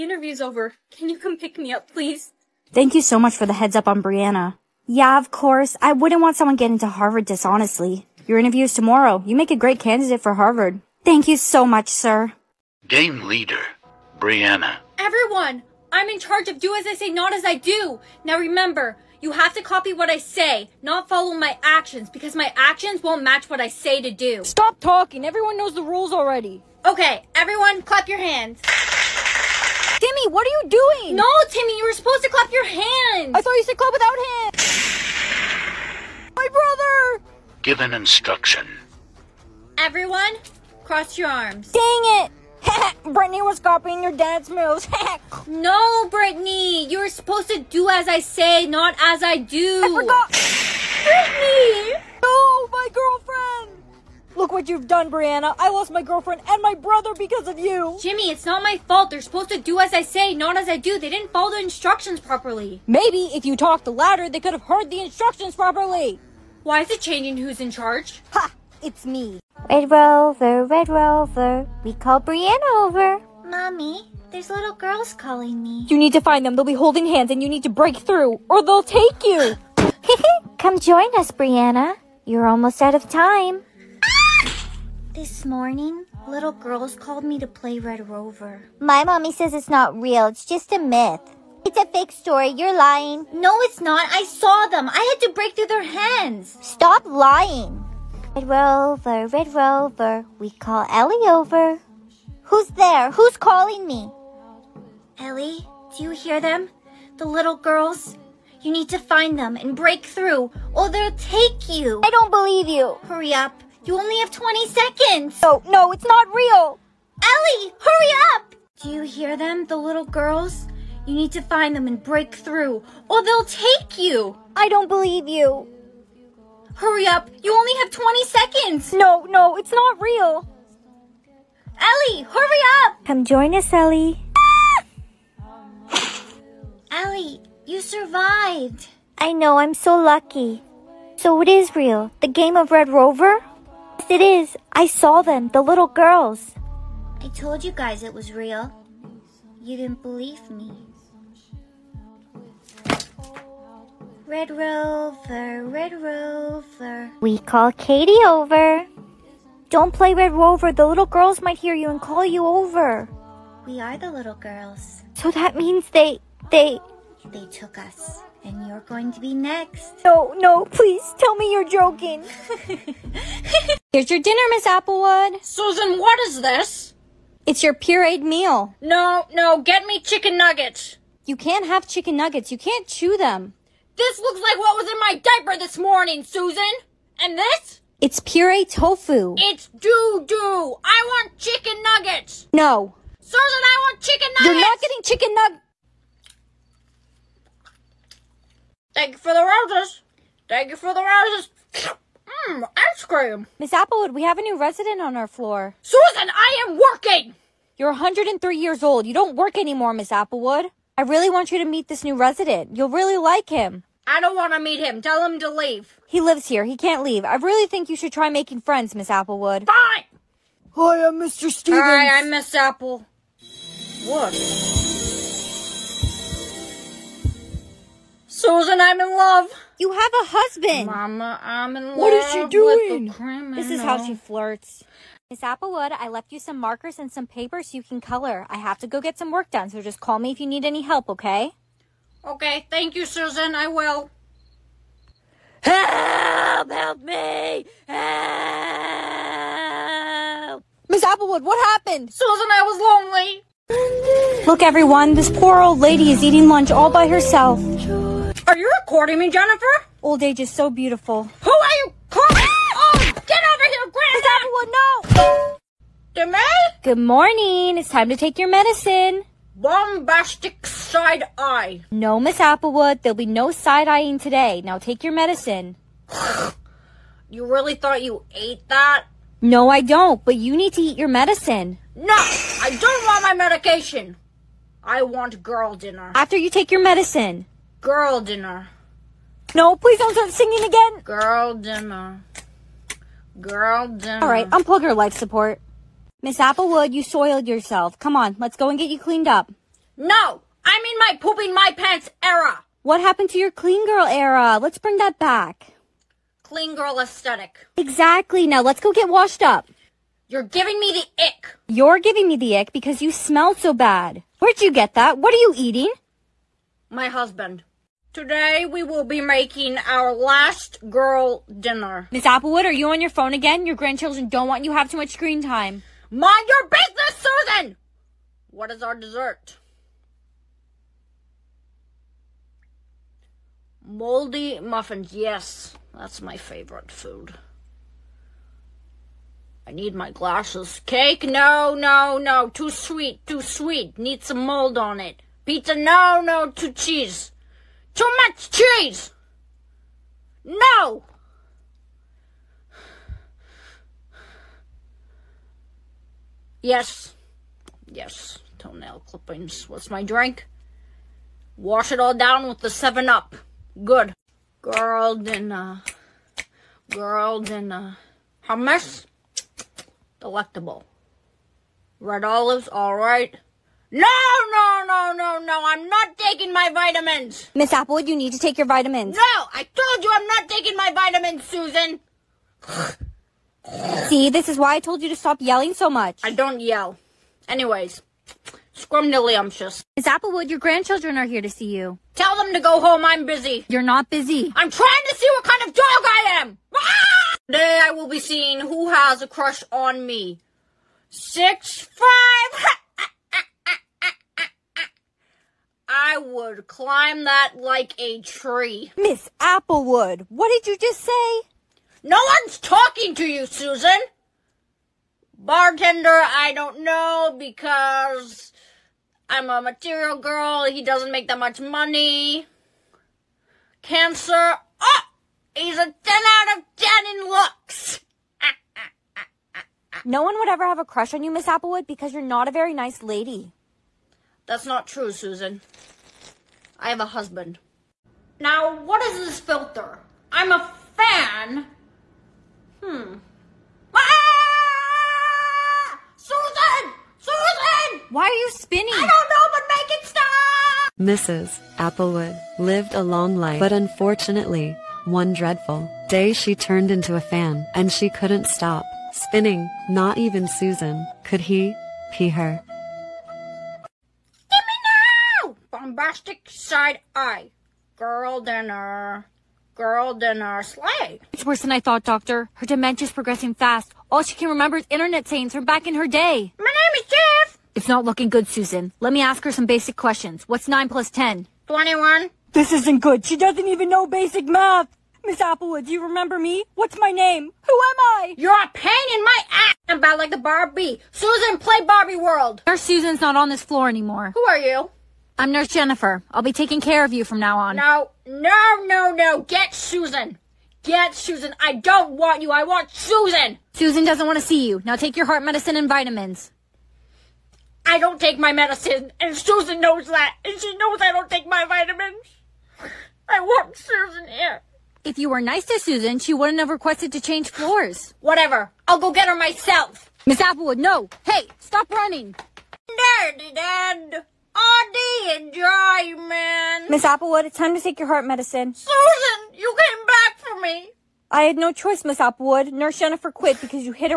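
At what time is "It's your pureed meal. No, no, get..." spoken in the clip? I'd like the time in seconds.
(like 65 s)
177 s.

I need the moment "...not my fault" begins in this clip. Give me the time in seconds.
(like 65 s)
58 s.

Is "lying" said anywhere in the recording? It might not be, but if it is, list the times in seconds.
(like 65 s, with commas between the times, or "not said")
92 s, 97 s.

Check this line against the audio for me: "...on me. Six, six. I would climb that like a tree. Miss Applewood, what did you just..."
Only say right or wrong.
wrong.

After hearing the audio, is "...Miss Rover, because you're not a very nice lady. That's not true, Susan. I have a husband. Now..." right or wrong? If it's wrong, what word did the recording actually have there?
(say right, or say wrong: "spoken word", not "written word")
wrong: "Applewood", not "Rover".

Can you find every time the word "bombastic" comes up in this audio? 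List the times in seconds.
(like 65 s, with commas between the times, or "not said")
269 s, 465 s.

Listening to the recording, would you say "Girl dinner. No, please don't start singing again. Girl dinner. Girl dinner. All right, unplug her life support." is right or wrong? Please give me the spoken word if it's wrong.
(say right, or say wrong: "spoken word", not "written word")
right.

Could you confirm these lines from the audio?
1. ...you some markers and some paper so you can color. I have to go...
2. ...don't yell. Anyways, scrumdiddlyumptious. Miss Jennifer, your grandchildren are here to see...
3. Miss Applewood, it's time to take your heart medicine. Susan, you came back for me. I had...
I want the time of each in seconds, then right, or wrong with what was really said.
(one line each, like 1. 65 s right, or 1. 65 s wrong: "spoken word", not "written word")
1. 236 s right
2. 386 s wrong: "Applewood", not "Jennifer"
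3. 526 s right.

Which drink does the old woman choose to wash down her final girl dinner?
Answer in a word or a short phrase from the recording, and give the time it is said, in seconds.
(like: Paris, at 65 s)
7 Up, at 361 s.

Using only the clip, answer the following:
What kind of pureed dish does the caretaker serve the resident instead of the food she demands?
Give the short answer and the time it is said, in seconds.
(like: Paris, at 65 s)
tofu, at 187 s.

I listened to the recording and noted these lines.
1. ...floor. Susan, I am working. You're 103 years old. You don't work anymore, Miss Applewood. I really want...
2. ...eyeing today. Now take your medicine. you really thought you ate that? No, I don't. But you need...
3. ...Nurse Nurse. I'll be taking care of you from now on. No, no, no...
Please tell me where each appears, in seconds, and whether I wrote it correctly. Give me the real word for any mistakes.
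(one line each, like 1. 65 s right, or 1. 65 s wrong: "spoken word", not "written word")
1. 205 s right
2. 273 s right
3. 495 s wrong: "Jennifer", not "Nurse".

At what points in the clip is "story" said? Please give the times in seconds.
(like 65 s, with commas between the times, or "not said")
92 s.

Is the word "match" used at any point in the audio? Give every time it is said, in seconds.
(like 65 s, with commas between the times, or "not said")
23 s.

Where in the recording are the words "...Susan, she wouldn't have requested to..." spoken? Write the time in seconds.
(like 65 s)
515 s.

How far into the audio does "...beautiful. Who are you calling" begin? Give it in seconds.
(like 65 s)
260 s.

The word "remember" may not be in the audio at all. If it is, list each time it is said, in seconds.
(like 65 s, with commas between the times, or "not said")
18 s, 474 s, 486 s.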